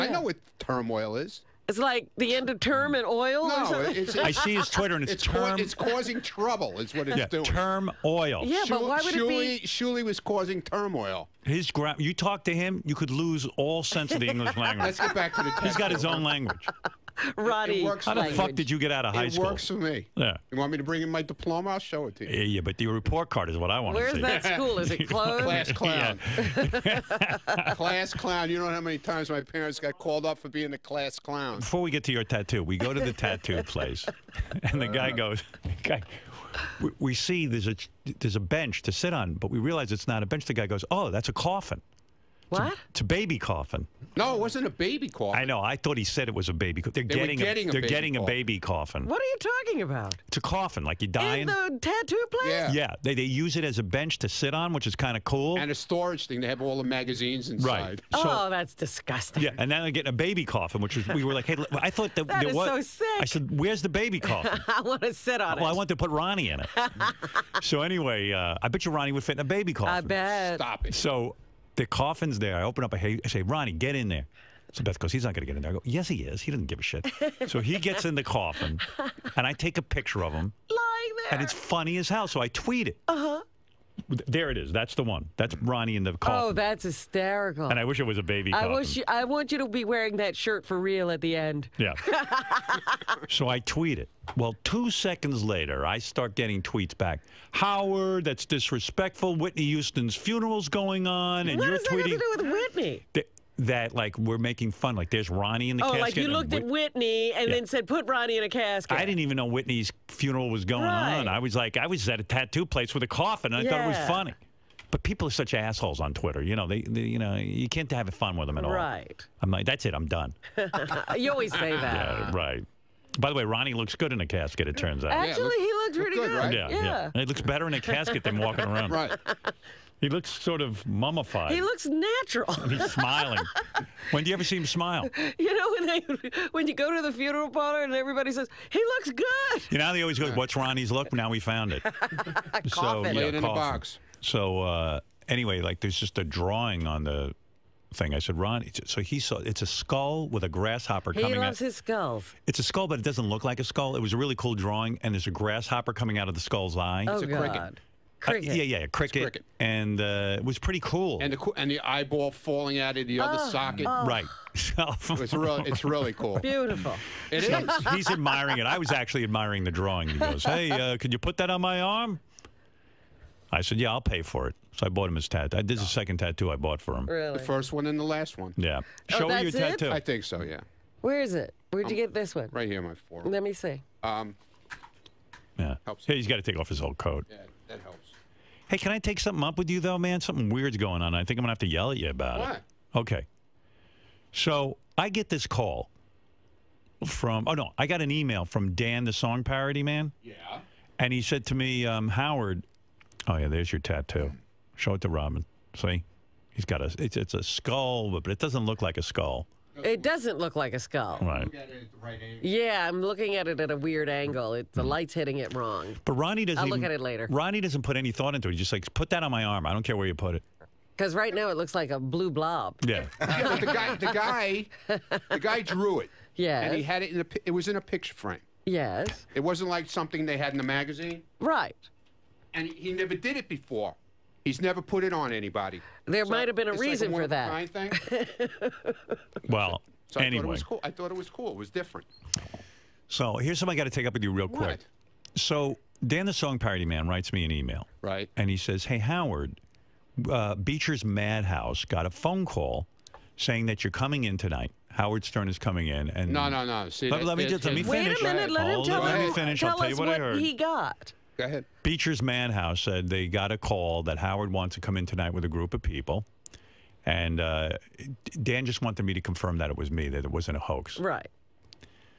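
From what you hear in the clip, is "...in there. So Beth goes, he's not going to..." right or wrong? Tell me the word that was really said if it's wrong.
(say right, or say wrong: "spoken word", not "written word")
right.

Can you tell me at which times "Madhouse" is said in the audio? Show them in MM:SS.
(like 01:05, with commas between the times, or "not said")
04:11, 04:22.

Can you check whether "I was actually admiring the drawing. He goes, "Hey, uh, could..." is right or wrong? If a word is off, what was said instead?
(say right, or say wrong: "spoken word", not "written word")
right.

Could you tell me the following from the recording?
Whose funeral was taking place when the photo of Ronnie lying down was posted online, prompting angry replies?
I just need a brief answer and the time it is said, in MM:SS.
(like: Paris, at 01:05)
Whitney Houston, at 01:39.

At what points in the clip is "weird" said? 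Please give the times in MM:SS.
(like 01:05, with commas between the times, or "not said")
03:10, 03:33.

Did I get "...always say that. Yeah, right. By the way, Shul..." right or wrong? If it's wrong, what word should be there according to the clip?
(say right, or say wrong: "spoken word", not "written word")
wrong: "Ronnie", not "Shul".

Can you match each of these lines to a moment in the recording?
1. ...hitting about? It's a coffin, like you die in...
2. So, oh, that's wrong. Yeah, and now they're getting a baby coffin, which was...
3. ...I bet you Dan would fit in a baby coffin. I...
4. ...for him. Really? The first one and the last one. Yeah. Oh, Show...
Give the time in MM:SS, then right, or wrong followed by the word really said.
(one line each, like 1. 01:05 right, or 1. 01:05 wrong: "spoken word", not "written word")
1. 00:49 wrong: "talking", not "hitting"
2. 00:58 wrong: "disgusting", not "wrong"
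3. 01:08 wrong: "Ronnie", not "Dan"
4. 02:56 right.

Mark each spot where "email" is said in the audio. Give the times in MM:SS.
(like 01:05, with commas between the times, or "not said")
03:18, 04:07.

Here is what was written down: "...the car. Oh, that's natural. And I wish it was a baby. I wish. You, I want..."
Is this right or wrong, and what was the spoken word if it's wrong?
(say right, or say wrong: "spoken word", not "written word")
wrong: "hysterical", not "natural".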